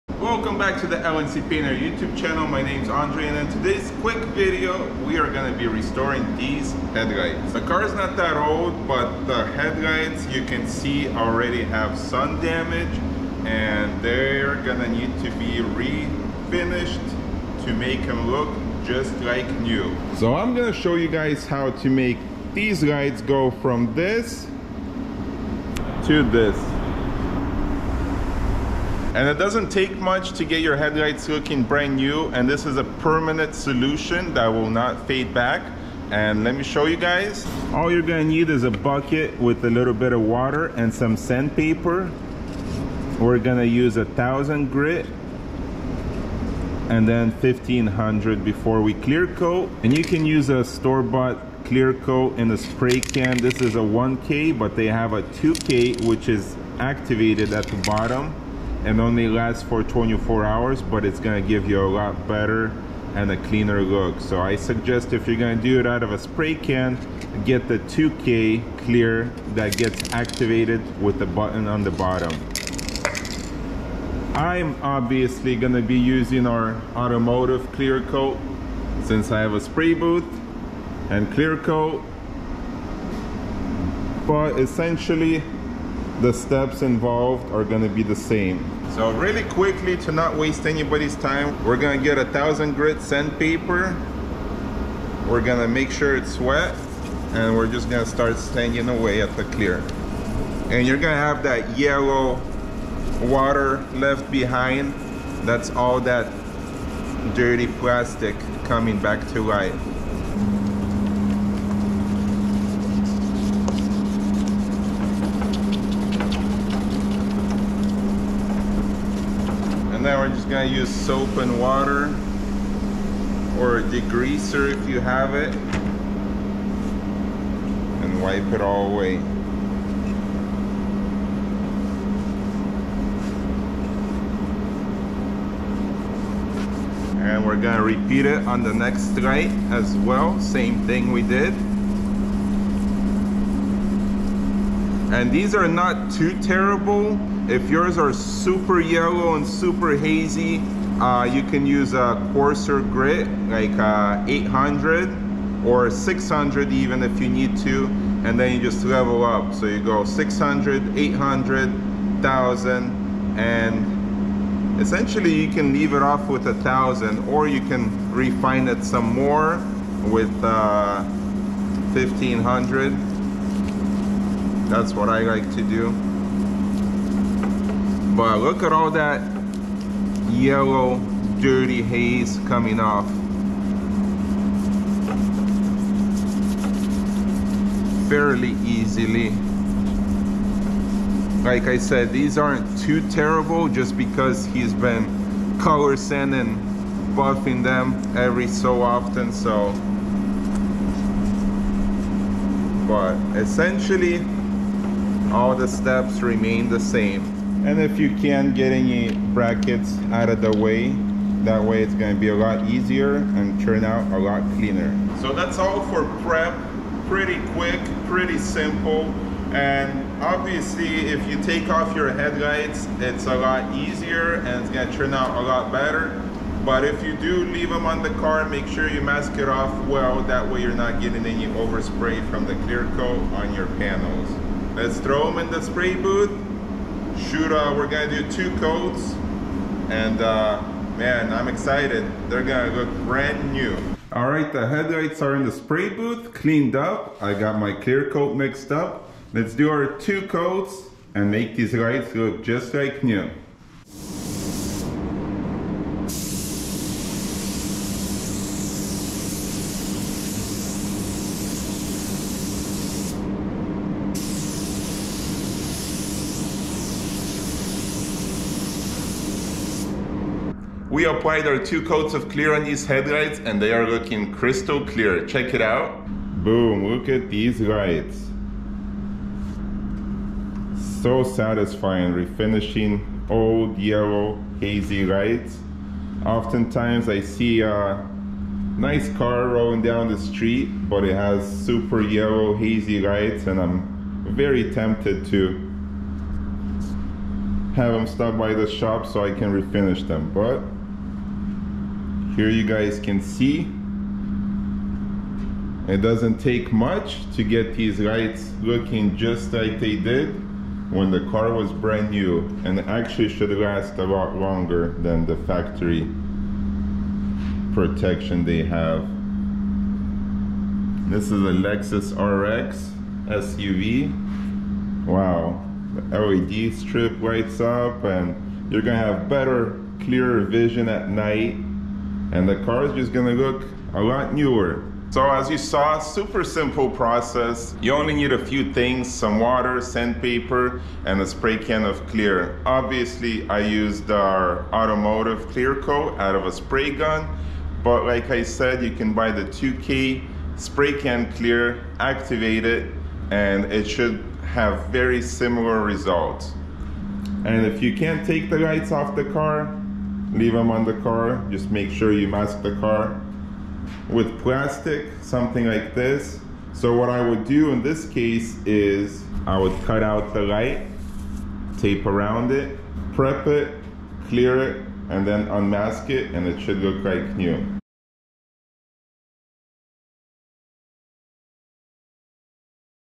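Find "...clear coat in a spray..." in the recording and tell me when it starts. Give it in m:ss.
0:51.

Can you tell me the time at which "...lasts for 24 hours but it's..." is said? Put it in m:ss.
0:59.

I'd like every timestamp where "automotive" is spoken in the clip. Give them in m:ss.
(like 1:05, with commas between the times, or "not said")
1:16, 5:44.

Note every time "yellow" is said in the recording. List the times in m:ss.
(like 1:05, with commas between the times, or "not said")
1:41, 2:28, 3:00, 4:43, 4:52.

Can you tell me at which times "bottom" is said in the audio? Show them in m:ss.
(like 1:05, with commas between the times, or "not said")
0:57, 1:11.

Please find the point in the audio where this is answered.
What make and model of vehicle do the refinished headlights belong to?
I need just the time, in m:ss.
5:21.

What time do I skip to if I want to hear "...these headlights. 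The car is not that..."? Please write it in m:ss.
0:06.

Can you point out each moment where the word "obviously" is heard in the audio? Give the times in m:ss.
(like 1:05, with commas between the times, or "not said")
1:14, 3:40, 5:42.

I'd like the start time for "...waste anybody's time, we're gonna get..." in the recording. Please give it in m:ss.
1:30.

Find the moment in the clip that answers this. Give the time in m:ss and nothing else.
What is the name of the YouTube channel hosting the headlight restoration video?
0:00.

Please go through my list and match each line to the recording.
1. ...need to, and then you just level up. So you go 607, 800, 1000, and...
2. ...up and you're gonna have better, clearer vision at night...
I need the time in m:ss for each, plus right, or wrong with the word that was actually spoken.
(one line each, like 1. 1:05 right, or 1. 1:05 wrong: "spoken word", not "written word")
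1. 2:37 wrong: "600", not "607"
2. 5:27 right.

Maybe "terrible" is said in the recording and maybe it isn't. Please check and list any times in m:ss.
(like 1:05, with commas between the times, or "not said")
2:26, 3:13.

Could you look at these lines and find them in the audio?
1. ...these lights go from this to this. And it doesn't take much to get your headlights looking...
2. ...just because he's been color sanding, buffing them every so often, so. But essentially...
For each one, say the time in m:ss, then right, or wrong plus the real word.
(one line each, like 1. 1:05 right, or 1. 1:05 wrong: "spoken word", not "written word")
1. 0:22 right
2. 3:13 right.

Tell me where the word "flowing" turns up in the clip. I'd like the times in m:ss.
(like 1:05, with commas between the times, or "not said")
not said.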